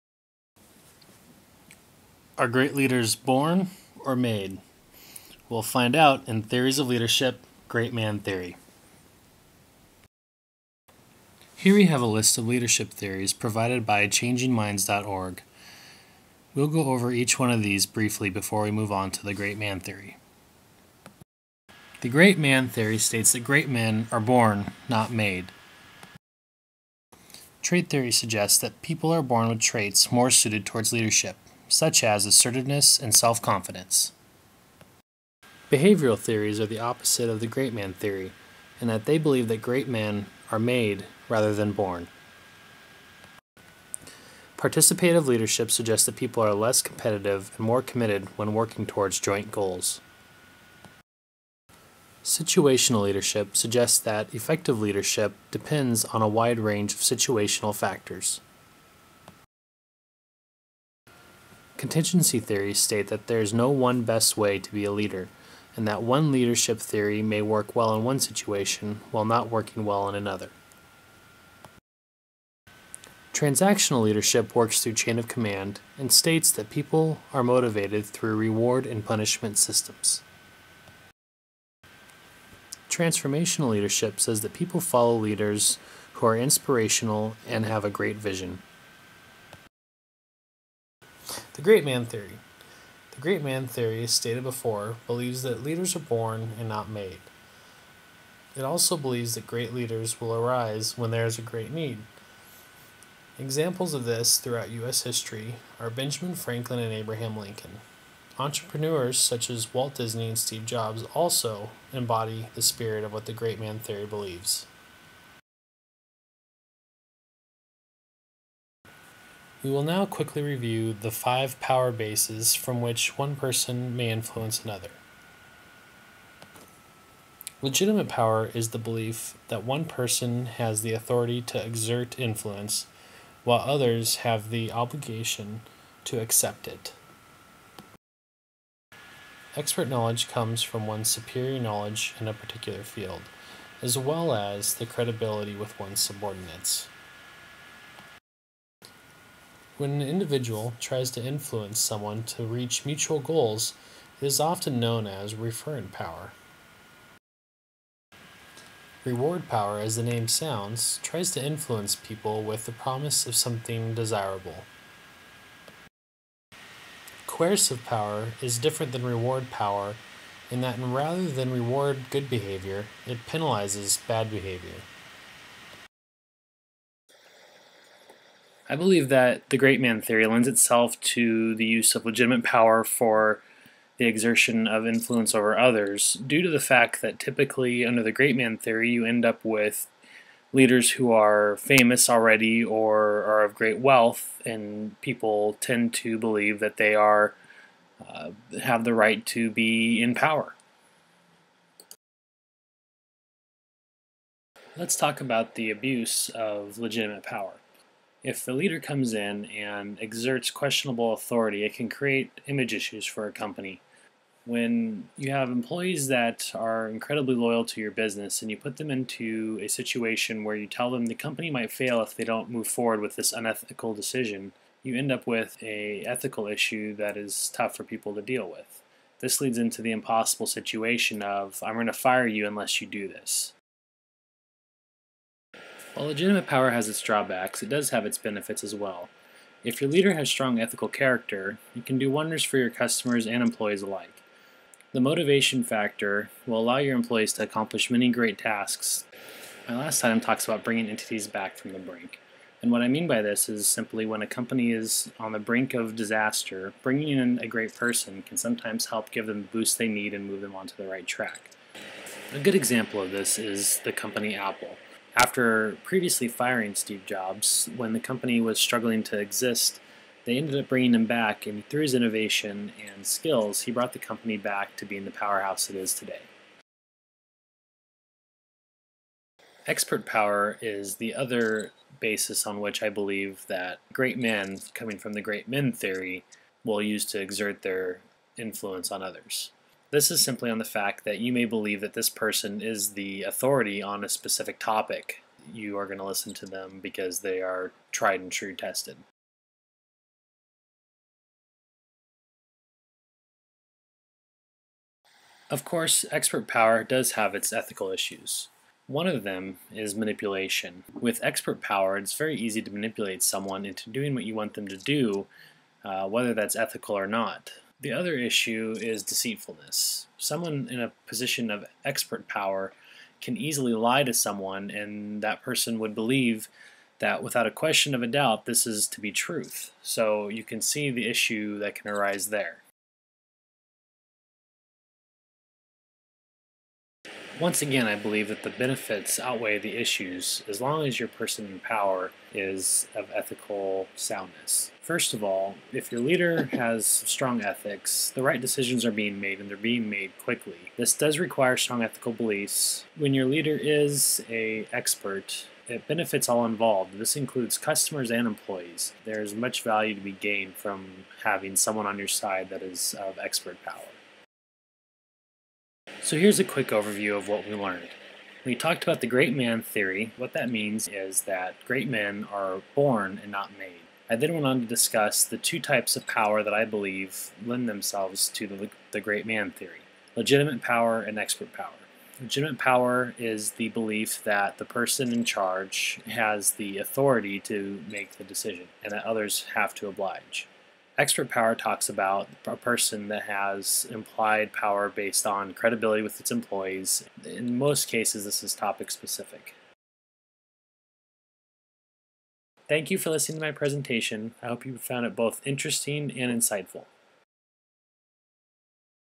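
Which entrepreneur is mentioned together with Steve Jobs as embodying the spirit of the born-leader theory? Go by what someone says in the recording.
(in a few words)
Walt Disney.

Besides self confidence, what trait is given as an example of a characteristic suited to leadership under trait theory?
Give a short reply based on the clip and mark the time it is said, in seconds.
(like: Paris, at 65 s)
Assertiveness, at 32 s.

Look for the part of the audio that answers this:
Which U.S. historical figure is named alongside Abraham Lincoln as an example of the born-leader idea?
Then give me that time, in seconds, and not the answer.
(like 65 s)
105 s.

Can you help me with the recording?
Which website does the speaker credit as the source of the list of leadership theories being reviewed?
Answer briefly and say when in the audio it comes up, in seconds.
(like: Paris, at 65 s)
changingminds.org, at 14 s.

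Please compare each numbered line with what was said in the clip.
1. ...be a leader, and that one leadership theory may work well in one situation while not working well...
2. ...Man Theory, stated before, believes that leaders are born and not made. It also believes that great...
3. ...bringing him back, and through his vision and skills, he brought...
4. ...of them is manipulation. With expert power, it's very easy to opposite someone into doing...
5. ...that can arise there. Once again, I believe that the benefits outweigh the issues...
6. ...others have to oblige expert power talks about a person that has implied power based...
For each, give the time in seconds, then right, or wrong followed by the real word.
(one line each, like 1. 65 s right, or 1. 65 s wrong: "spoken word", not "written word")
1. 64 s right
2. 93 s right
3. 270 s wrong: "innovation", not "vision"
4. 309 s wrong: "manipulate", not "opposite"
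5. 331 s right
6. 389 s right.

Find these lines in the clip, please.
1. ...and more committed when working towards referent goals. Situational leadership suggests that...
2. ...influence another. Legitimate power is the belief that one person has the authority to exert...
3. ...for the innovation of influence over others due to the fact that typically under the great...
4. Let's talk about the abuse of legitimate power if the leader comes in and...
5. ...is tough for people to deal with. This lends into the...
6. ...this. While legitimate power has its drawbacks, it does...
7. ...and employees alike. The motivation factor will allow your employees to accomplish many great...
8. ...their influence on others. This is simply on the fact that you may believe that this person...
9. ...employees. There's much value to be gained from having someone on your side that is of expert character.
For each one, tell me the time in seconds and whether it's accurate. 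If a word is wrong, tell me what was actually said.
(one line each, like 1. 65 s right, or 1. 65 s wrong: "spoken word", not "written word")
1. 47 s wrong: "joint", not "referent"
2. 124 s right
3. 182 s wrong: "exertion", not "innovation"
4. 204 s right
5. 227 s wrong: "leads", not "lends"
6. 233 s right
7. 243 s right
8. 287 s right
9. 358 s wrong: "power", not "character".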